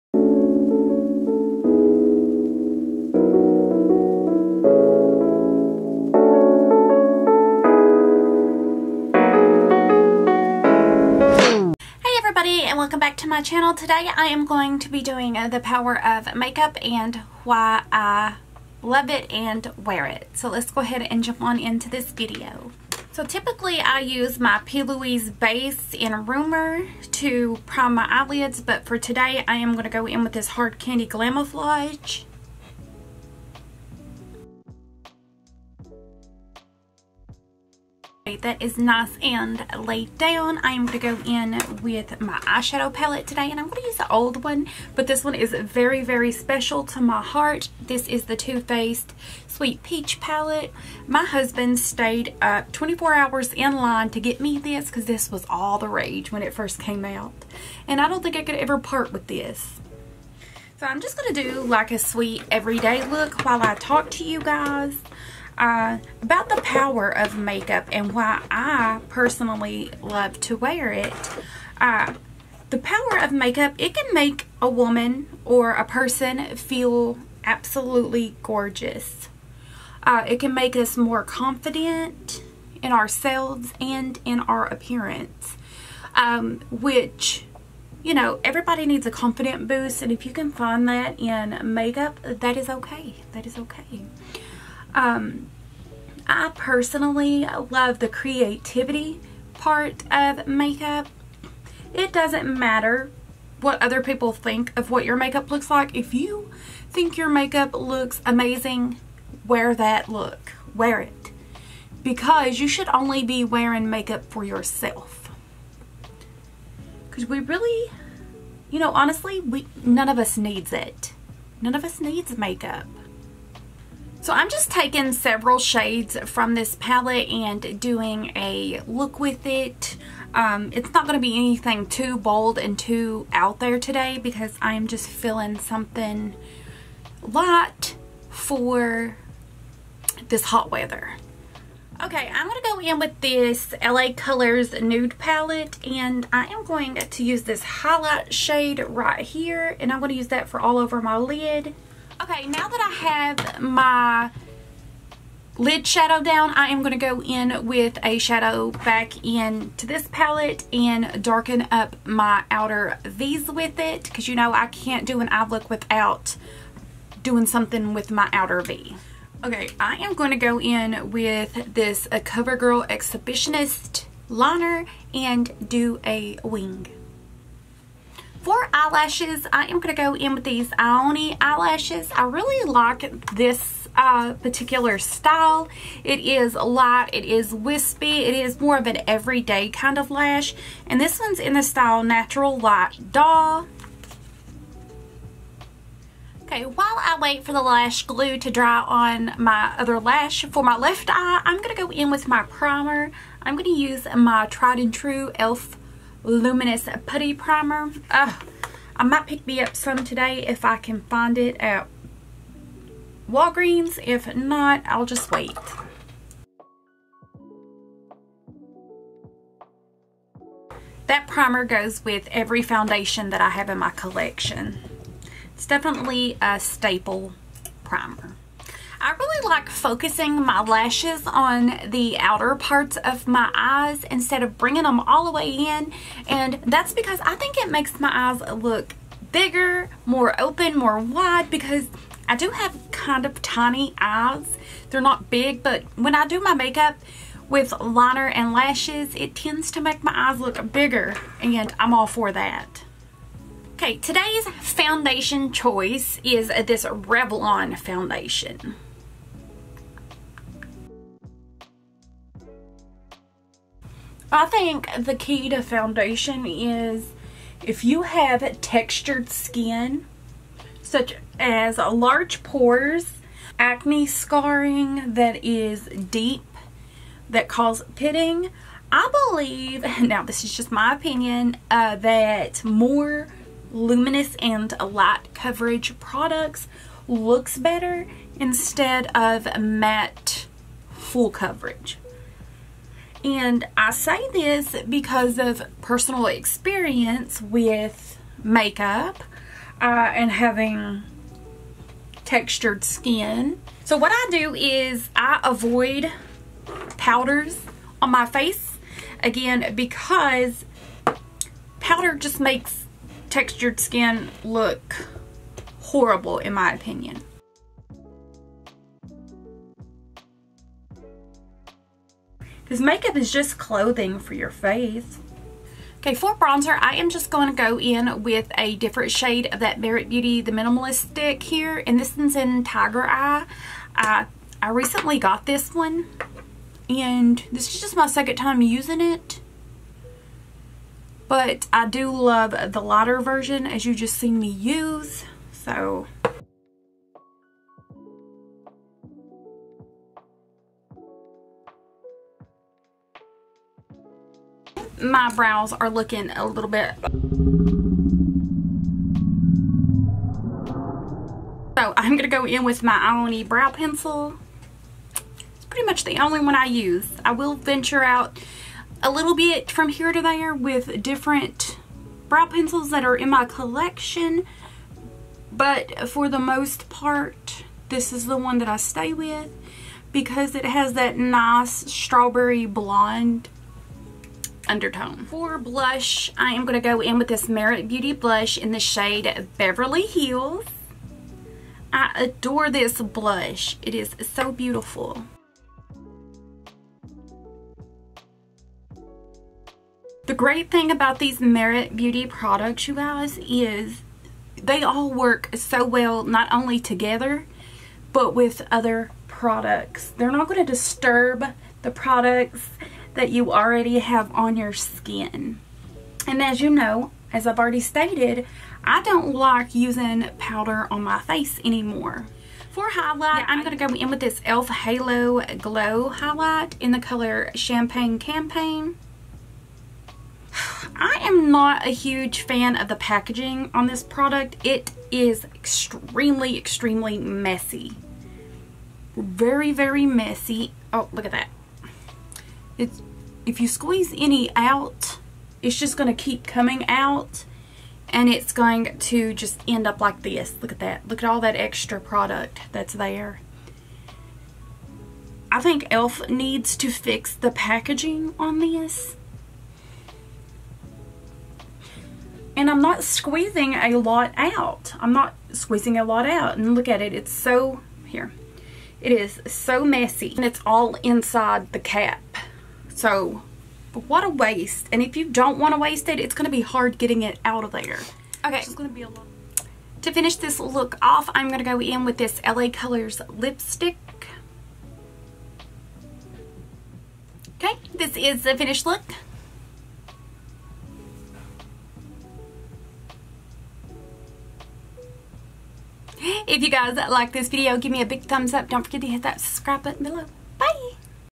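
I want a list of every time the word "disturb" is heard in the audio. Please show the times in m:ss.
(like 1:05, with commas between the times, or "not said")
6:50.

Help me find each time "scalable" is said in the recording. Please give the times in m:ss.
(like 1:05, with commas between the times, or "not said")
not said.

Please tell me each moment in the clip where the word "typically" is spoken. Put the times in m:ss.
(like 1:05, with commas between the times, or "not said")
0:23.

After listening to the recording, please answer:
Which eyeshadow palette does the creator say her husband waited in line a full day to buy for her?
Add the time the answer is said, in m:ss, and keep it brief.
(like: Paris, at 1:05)
Too Faced Sweet Peach, at 0:48.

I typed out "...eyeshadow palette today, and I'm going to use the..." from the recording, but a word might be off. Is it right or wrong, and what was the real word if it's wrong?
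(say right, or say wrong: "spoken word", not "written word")
right.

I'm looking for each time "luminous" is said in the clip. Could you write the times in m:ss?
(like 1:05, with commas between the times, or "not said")
3:26, 4:43.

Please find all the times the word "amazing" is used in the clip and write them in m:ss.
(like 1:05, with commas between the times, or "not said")
1:48.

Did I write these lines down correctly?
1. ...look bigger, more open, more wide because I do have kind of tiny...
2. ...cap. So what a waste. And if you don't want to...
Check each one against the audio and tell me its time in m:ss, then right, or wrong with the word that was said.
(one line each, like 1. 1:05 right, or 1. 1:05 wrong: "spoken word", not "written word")
1. 3:58 right
2. 7:51 right.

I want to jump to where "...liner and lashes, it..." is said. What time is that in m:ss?
4:07.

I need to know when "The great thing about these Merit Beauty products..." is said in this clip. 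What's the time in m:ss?
6:40.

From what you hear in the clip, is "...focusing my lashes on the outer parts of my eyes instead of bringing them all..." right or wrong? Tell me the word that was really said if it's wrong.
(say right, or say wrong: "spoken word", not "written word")
right.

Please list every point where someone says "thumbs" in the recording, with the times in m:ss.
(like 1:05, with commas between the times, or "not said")
8:18.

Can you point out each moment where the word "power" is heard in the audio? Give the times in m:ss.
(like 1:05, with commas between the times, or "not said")
0:15, 1:06, 1:12.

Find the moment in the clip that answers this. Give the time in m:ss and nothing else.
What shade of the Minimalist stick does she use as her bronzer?
5:32.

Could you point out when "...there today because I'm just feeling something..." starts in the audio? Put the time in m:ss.
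2:13.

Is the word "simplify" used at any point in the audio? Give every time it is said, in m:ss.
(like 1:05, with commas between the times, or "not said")
not said.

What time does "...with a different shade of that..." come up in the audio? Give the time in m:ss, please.
5:28.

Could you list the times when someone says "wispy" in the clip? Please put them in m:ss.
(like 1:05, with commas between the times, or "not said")
3:07.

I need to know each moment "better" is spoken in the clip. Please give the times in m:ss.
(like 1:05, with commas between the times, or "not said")
4:47.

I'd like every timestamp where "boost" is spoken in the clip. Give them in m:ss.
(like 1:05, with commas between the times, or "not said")
1:29.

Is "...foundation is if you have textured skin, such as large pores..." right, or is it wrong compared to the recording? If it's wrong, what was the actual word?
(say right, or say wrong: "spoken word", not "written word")
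right.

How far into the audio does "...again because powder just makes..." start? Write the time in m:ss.
5:09.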